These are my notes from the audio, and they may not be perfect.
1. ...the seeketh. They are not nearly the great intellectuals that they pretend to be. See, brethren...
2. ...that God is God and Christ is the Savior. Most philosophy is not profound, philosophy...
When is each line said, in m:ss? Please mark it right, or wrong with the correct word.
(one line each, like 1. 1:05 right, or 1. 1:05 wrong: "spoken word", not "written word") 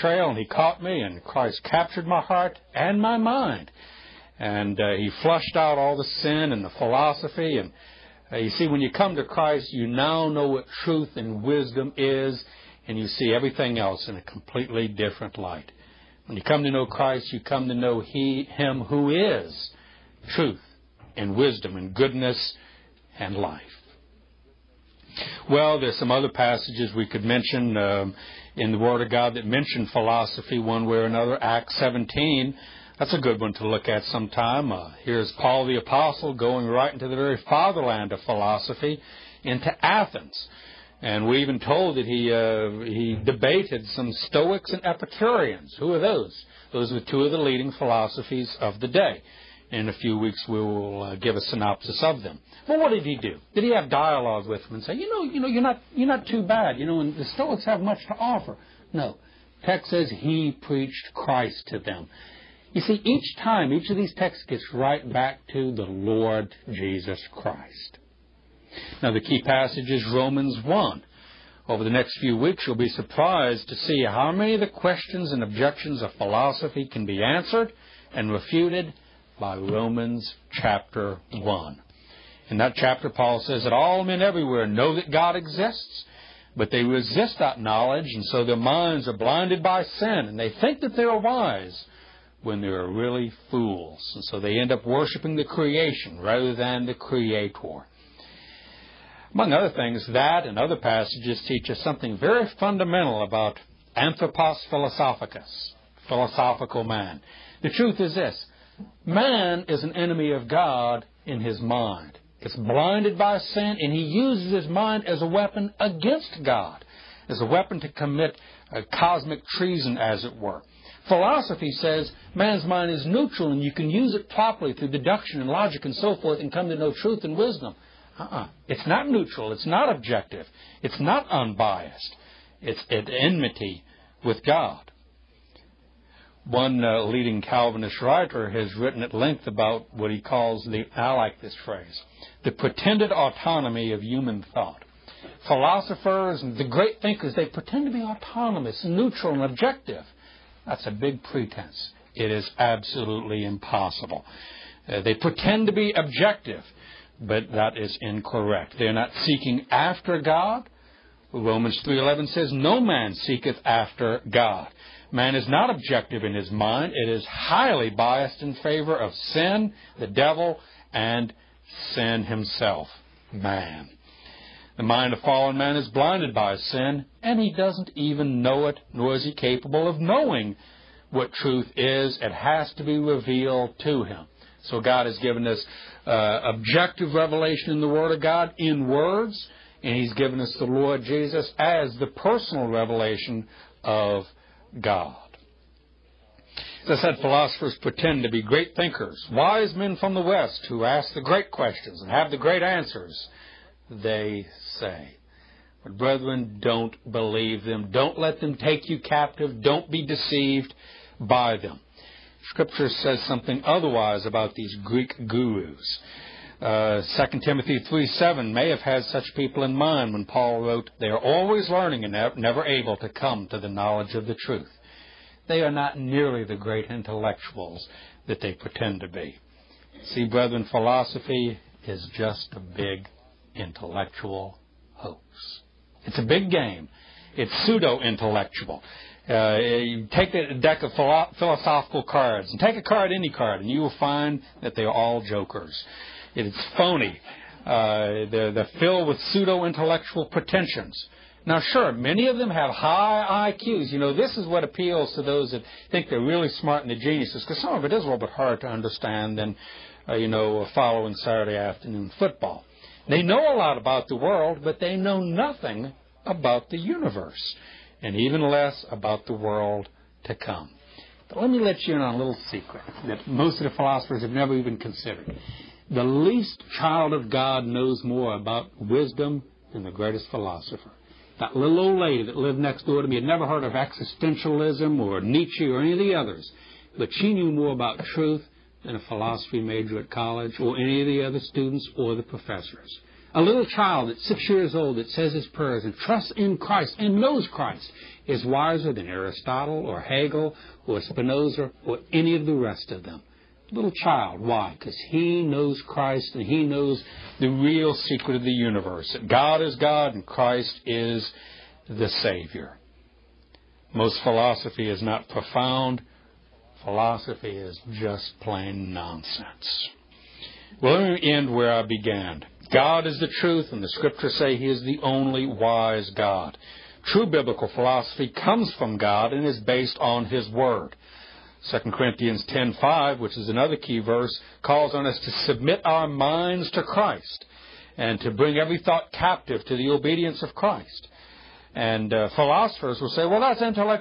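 1. 3:44 wrong: "truth", not "seeketh"
2. 5:09 right.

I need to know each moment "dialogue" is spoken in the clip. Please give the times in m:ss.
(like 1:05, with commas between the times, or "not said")
0:53.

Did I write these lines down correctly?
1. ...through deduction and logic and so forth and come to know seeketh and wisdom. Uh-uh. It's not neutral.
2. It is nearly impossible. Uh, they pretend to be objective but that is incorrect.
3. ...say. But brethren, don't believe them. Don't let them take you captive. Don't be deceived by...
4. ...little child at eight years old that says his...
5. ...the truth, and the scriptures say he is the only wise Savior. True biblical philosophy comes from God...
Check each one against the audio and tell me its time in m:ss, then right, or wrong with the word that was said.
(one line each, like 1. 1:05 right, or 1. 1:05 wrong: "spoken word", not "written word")
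1. 2:04 wrong: "truth", not "seeketh"
2. 2:32 wrong: "absolutely", not "nearly"
3. 3:24 right
4. 4:53 wrong: "six", not "eight"
5. 5:23 wrong: "God", not "Savior".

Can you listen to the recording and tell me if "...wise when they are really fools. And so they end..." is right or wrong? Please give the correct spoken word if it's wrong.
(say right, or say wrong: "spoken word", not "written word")
right.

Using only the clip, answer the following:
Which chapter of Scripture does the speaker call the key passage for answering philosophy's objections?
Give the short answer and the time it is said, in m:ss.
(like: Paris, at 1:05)
Romans 1, at 1:10.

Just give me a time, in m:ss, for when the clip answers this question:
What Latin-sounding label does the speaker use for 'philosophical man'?
1:43.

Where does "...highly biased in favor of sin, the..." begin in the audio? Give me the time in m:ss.
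2:47.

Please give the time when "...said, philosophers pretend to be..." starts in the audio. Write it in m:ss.
3:17.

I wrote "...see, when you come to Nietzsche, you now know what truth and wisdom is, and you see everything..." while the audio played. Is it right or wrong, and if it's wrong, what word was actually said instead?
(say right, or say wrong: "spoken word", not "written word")
wrong: "Christ", not "Nietzsche".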